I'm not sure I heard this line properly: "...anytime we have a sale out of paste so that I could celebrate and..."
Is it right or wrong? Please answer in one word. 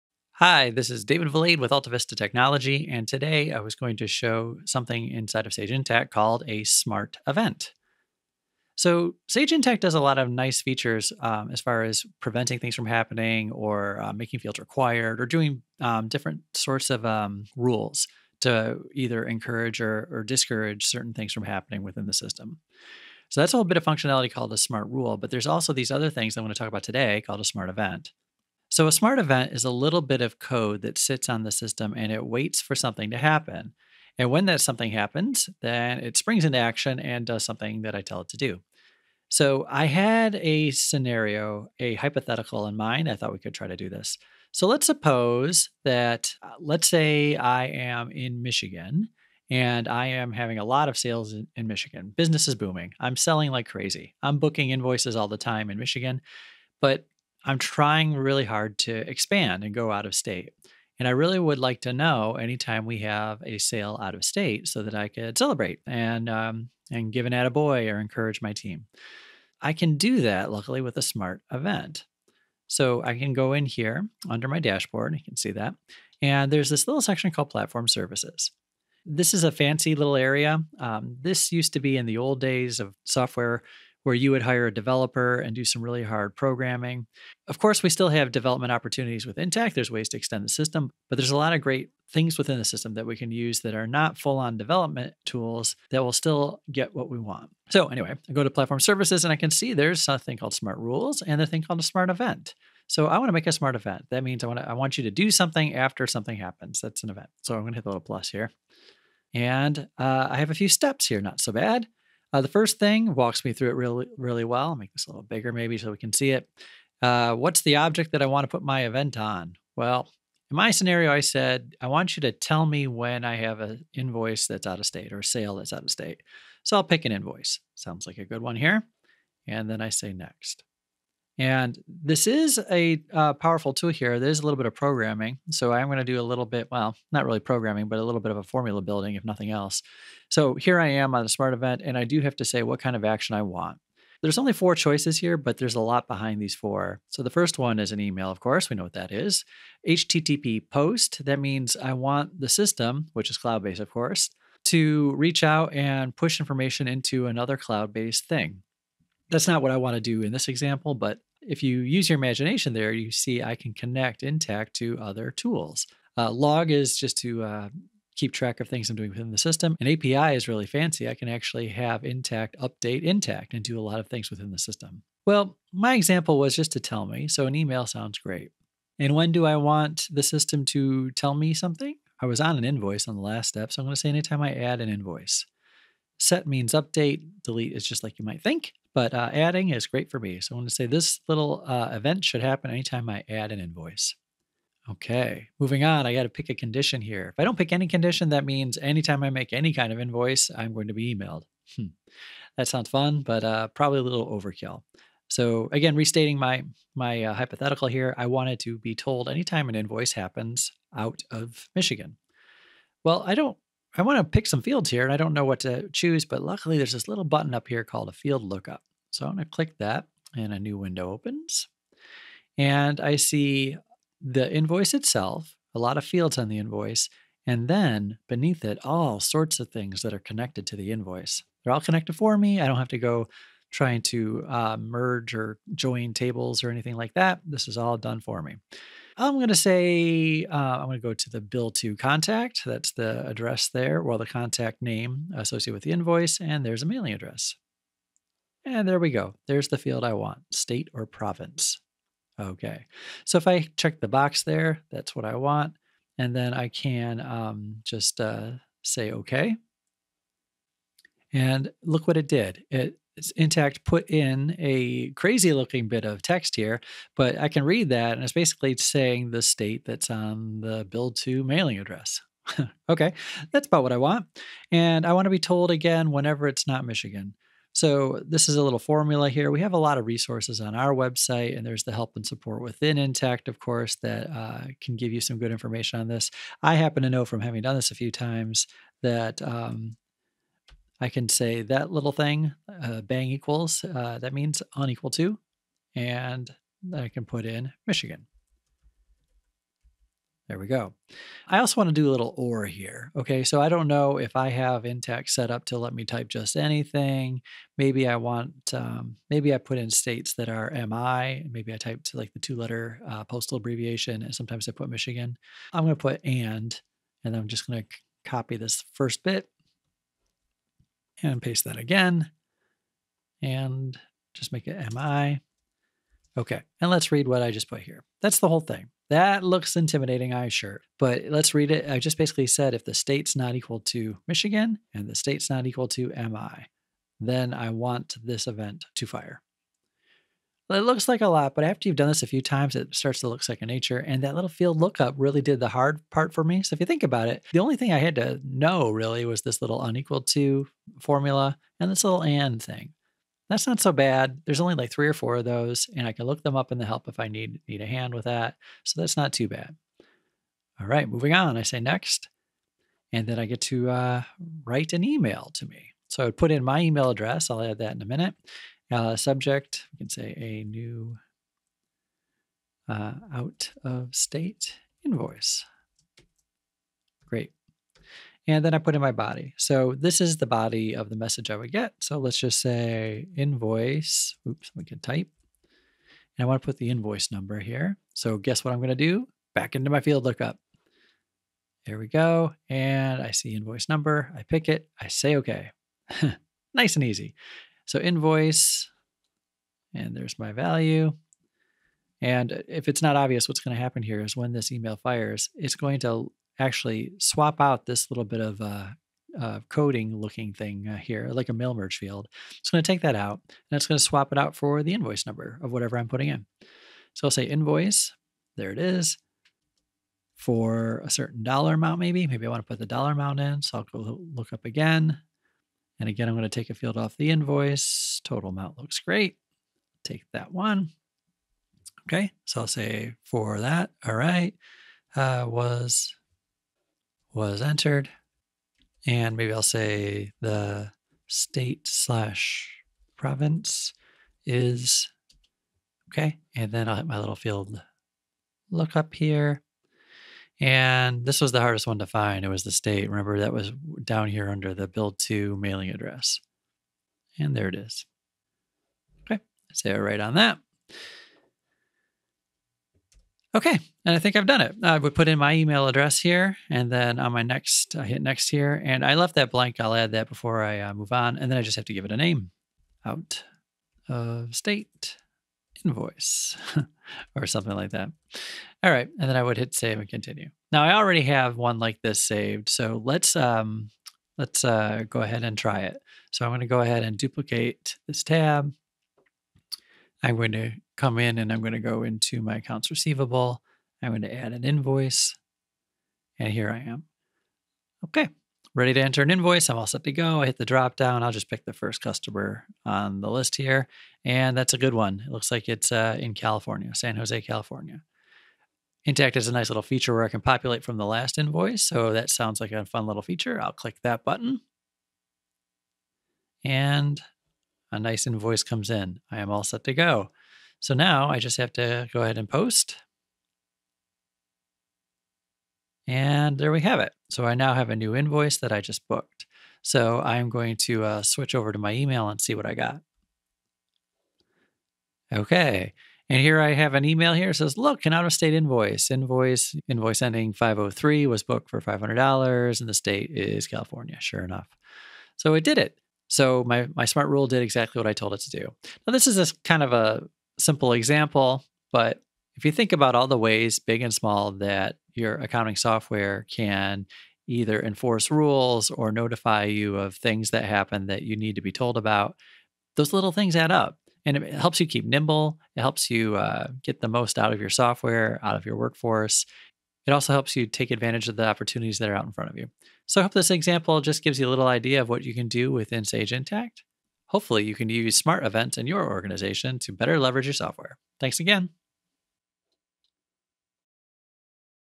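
wrong.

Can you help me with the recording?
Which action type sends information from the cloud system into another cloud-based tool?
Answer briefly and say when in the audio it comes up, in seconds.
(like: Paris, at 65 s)
HTTP post, at 149 s.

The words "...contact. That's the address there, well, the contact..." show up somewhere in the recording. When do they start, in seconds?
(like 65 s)
241 s.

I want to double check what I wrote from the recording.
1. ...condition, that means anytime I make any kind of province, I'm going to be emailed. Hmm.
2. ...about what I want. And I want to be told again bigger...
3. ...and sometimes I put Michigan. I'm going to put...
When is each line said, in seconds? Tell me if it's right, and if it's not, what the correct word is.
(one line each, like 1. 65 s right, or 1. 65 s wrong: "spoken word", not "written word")
1. 197 s wrong: "invoice", not "province"
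2. 273 s wrong: "whenever", not "bigger"
3. 314 s right.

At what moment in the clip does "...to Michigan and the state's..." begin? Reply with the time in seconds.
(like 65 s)
333 s.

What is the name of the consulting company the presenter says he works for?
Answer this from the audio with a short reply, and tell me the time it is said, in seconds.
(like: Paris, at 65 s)
AltaVista Technology, at 1 s.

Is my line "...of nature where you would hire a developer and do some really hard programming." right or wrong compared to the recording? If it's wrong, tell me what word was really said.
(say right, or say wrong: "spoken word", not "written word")
wrong: "software", not "nature".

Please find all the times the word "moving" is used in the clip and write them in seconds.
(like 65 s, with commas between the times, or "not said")
195 s, 361 s.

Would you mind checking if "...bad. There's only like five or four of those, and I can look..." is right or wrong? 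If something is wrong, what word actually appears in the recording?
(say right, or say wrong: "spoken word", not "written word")
wrong: "three", not "five".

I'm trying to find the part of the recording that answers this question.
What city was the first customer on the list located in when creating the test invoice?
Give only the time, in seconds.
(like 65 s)
506 s.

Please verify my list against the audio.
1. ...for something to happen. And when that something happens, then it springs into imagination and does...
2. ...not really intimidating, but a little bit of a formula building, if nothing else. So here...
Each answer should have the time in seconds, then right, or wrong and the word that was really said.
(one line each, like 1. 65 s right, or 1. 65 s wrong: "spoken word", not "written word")
1. 32 s wrong: "action", not "imagination"
2. 137 s wrong: "programming", not "intimidating".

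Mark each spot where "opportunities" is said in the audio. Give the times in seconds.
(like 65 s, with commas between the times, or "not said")
88 s, 571 s.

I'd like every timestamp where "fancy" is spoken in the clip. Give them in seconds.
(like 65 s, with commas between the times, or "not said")
79 s, 170 s.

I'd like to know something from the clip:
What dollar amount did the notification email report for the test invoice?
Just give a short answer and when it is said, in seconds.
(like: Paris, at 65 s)
$500, at 541 s.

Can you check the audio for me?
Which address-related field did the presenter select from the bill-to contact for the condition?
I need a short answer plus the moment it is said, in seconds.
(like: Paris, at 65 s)
State or province, at 250 s.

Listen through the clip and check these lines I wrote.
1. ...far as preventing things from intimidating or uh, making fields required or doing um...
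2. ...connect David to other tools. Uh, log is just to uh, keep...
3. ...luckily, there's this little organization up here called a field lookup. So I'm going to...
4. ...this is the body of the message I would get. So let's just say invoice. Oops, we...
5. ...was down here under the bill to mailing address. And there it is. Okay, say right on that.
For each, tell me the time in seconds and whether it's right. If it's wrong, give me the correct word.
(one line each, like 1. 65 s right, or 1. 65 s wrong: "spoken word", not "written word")
1. 11 s wrong: "happening", not "intimidating"
2. 163 s wrong: "Intacct", not "David"
3. 216 s wrong: "button", not "organization"
4. 379 s right
5. 453 s right.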